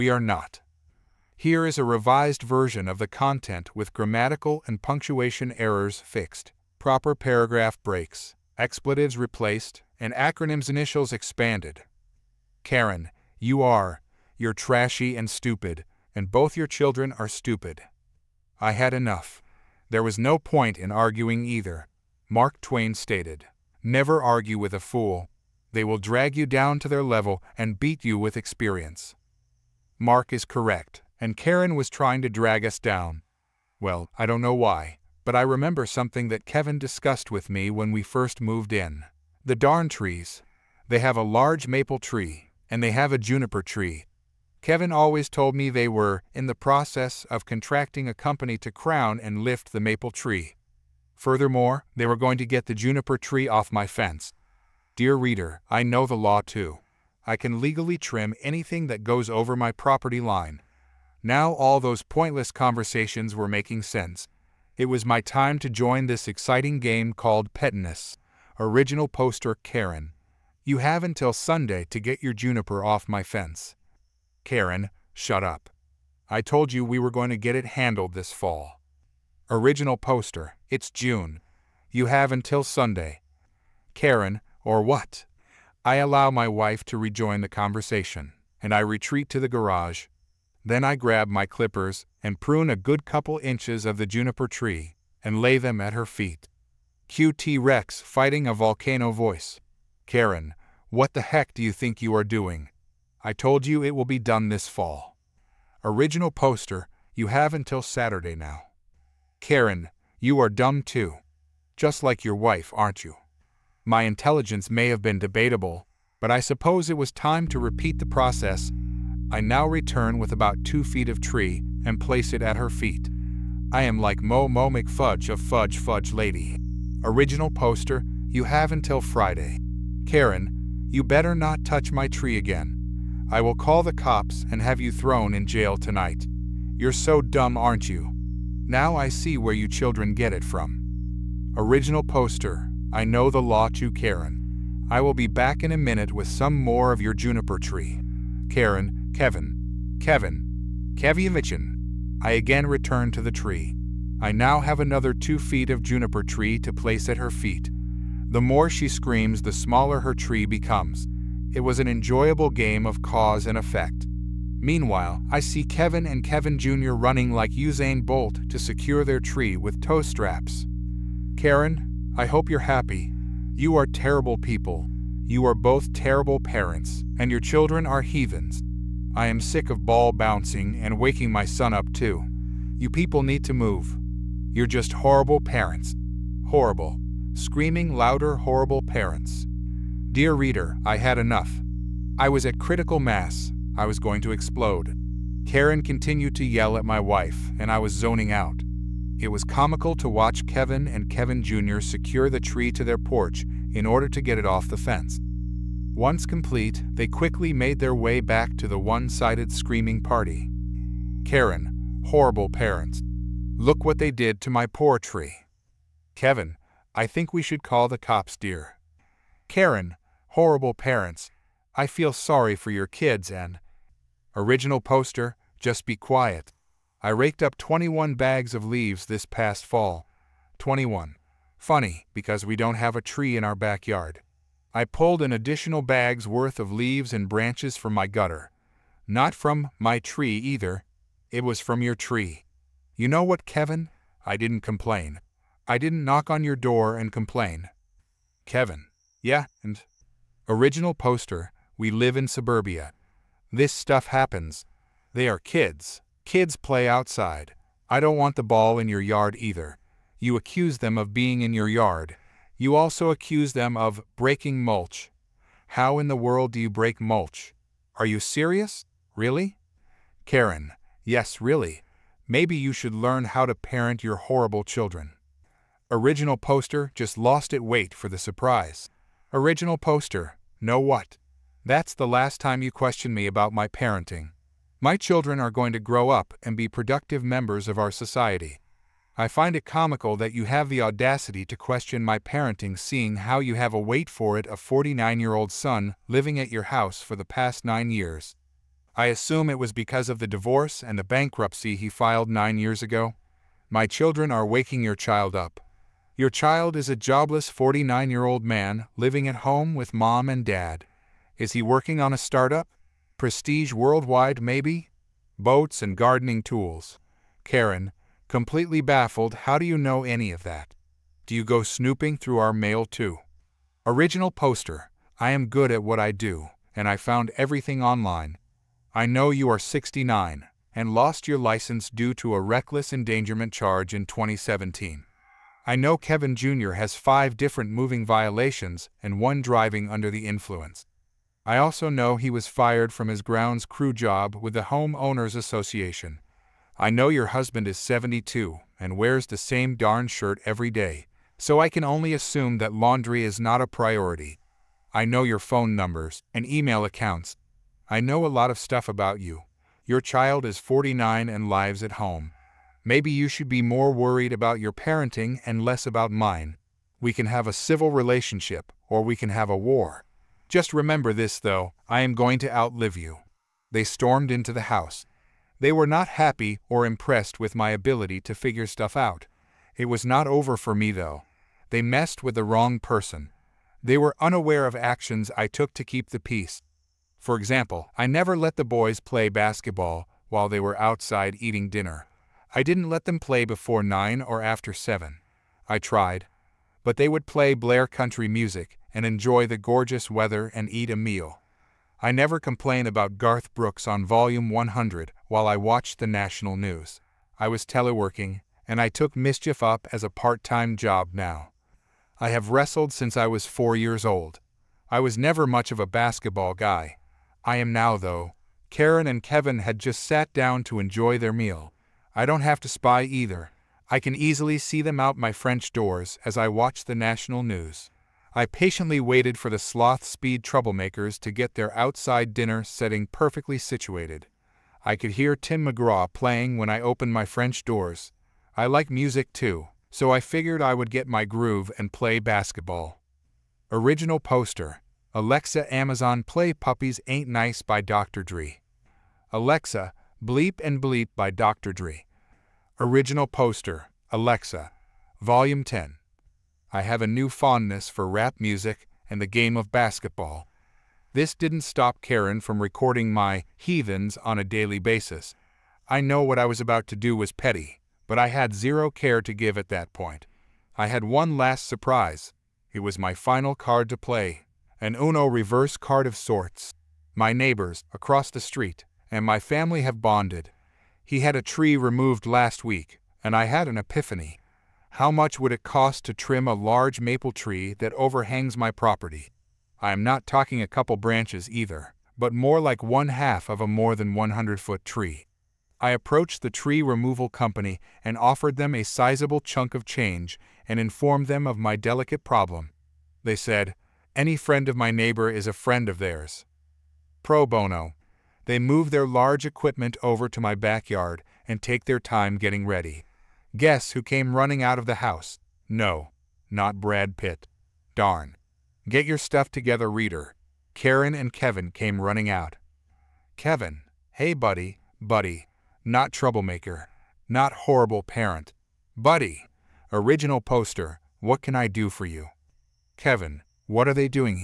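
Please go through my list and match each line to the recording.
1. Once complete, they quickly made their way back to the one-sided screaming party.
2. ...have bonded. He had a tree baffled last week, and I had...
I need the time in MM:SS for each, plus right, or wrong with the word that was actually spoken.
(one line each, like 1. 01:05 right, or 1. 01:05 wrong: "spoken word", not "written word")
1. 03:25 right
2. 07:59 wrong: "removed", not "baffled".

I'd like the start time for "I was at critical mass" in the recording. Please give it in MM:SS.
03:12.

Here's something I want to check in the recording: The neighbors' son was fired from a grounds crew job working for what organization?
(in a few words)
Homeowners Association.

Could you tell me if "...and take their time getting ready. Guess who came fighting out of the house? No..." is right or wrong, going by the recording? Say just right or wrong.
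wrong.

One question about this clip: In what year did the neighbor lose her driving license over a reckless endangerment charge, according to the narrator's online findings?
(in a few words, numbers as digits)
2017.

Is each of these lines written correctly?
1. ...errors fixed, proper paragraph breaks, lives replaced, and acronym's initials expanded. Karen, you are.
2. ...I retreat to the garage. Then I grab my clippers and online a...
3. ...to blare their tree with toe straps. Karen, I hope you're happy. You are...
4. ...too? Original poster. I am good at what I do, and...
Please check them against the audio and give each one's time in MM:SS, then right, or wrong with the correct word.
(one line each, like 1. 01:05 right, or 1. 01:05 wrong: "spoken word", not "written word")
1. 00:05 wrong: "expletives", not "lives"
2. 01:28 wrong: "prune", not "online"
3. 02:48 wrong: "secure", not "blare"
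4. 05:22 right.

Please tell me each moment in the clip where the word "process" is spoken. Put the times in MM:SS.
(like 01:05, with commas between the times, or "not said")
00:46, 01:58.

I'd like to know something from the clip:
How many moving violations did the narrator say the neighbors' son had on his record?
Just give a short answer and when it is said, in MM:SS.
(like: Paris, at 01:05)
5, at 05:36.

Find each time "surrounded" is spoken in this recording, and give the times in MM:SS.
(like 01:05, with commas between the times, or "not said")
not said.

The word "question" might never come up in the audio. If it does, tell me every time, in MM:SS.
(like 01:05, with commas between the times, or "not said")
04:42, 04:51.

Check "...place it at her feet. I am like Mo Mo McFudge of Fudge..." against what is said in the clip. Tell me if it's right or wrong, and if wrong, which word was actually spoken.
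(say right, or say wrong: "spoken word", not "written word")
right.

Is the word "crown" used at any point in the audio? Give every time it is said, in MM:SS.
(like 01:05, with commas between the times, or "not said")
00:48.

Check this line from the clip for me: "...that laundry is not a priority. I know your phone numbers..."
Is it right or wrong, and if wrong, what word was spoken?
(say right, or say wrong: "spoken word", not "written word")
right.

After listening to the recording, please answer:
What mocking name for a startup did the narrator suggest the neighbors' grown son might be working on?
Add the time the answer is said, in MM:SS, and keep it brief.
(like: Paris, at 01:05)
Prestige Worldwide, at 05:13.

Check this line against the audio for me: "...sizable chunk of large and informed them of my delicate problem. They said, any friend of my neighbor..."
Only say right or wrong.
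wrong.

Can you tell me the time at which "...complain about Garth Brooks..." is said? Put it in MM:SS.
06:42.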